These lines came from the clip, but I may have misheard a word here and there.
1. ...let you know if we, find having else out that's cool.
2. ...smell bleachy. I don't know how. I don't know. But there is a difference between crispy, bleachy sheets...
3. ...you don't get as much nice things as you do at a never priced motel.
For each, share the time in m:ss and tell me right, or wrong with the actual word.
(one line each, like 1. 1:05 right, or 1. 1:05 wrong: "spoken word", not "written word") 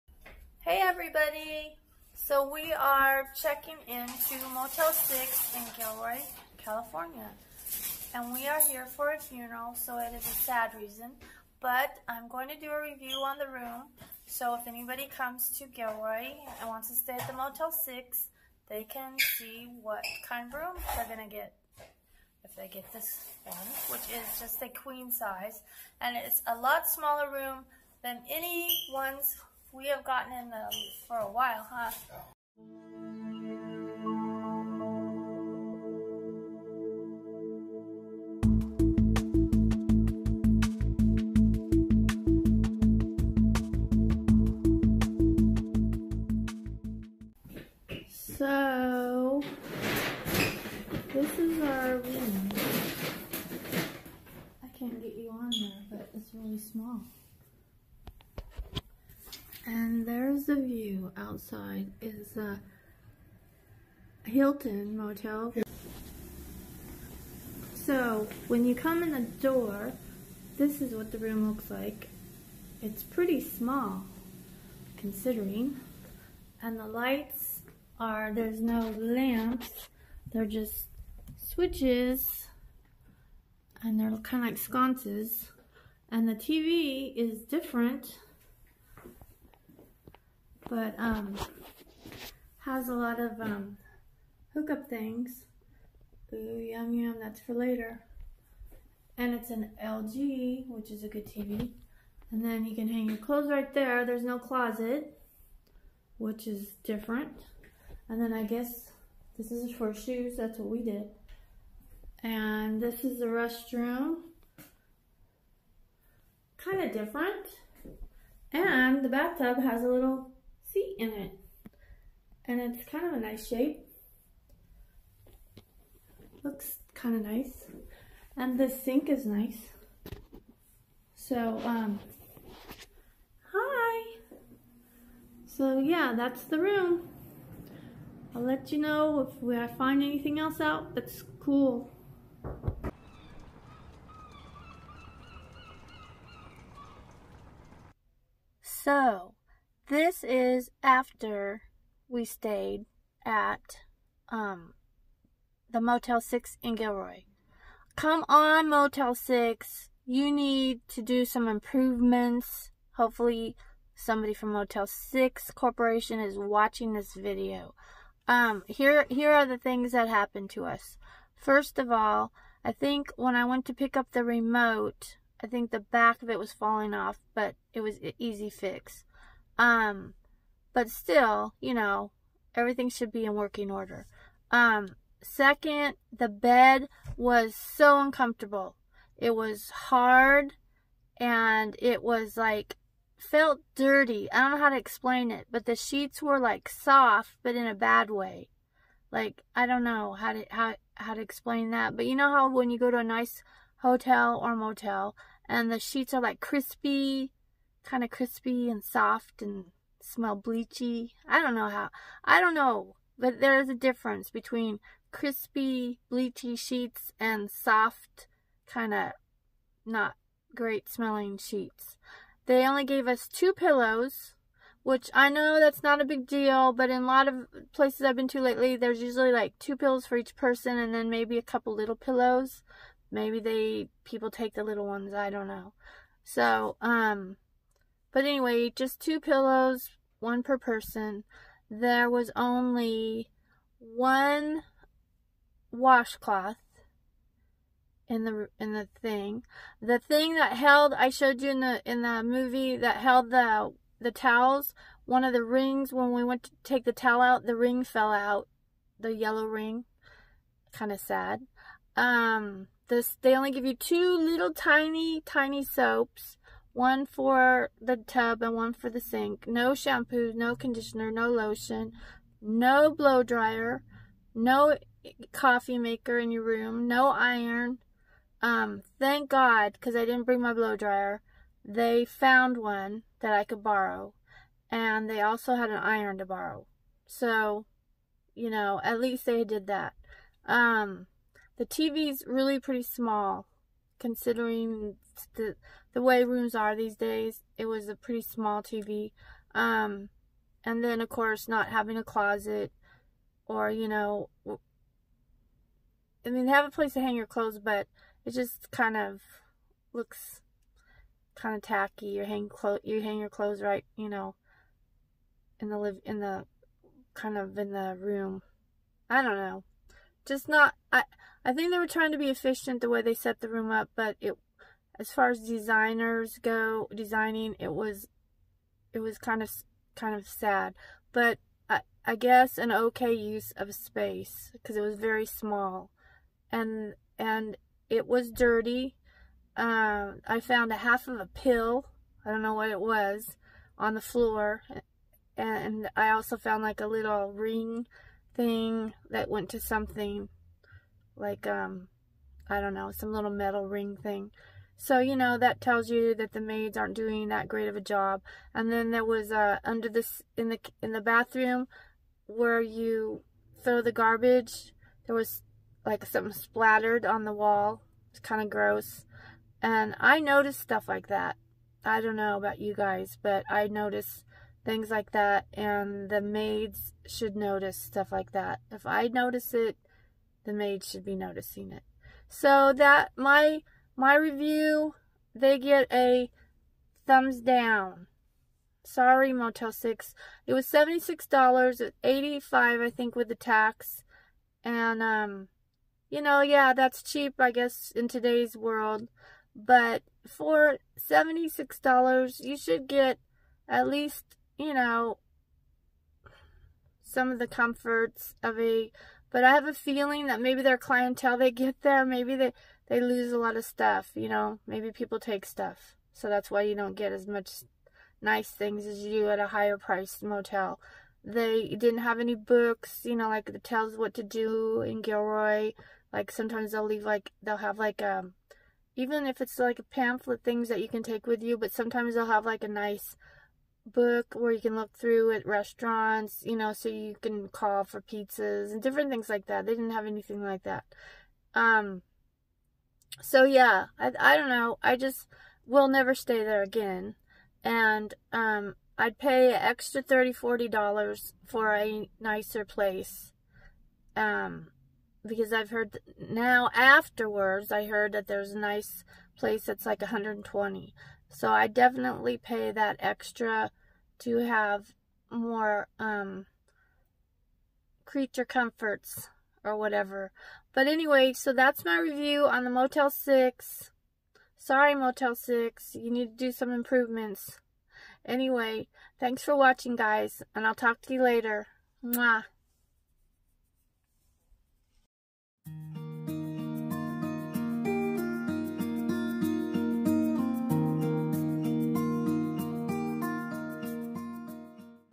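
1. 2:18 wrong: "anything", not "having"
2. 3:30 right
3. 6:56 wrong: "higher", not "never".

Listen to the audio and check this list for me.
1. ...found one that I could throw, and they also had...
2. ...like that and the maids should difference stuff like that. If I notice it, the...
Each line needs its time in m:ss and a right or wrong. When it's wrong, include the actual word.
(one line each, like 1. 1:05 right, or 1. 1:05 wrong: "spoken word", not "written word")
1. 4:42 wrong: "borrow", not "throw"
2. 6:14 wrong: "notice", not "difference".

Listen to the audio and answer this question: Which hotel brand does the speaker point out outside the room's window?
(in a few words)
Hilton.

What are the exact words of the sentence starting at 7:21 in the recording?
Um, so yeah, I, I don't know.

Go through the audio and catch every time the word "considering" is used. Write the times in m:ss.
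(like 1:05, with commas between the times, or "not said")
1:14, 4:54.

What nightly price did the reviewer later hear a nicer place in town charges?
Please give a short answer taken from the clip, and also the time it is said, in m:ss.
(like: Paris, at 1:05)
$120, at 7:40.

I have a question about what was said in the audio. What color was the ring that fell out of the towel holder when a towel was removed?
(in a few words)
yellow.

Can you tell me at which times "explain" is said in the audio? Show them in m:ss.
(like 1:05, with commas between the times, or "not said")
3:14, 3:21.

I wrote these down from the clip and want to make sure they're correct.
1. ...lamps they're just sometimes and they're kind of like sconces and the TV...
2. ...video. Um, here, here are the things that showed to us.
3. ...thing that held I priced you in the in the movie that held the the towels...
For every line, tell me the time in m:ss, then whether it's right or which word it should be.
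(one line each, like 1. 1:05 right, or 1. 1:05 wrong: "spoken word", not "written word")
1. 1:18 wrong: "switches", not "sometimes"
2. 2:47 wrong: "happened", not "showed"
3. 4:09 wrong: "showed", not "priced".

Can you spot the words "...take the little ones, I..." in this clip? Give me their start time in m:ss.
3:54.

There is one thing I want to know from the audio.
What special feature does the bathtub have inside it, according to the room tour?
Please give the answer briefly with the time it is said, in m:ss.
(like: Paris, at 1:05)
a little seat, at 1:59.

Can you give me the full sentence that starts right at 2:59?
Um, but still, you know, everything should be in working order.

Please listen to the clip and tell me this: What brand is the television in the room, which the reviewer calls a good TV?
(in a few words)
LG.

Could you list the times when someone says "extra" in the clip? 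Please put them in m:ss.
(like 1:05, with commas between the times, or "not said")
7:29, 7:42.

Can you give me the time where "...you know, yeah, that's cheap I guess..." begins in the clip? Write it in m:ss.
6:36.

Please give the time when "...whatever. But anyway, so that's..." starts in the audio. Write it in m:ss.
7:49.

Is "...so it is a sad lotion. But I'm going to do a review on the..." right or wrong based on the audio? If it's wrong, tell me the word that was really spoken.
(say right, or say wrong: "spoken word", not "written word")
wrong: "reason", not "lotion".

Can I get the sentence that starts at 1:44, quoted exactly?
There's no closet, which is different.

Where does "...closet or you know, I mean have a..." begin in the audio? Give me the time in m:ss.
5:02.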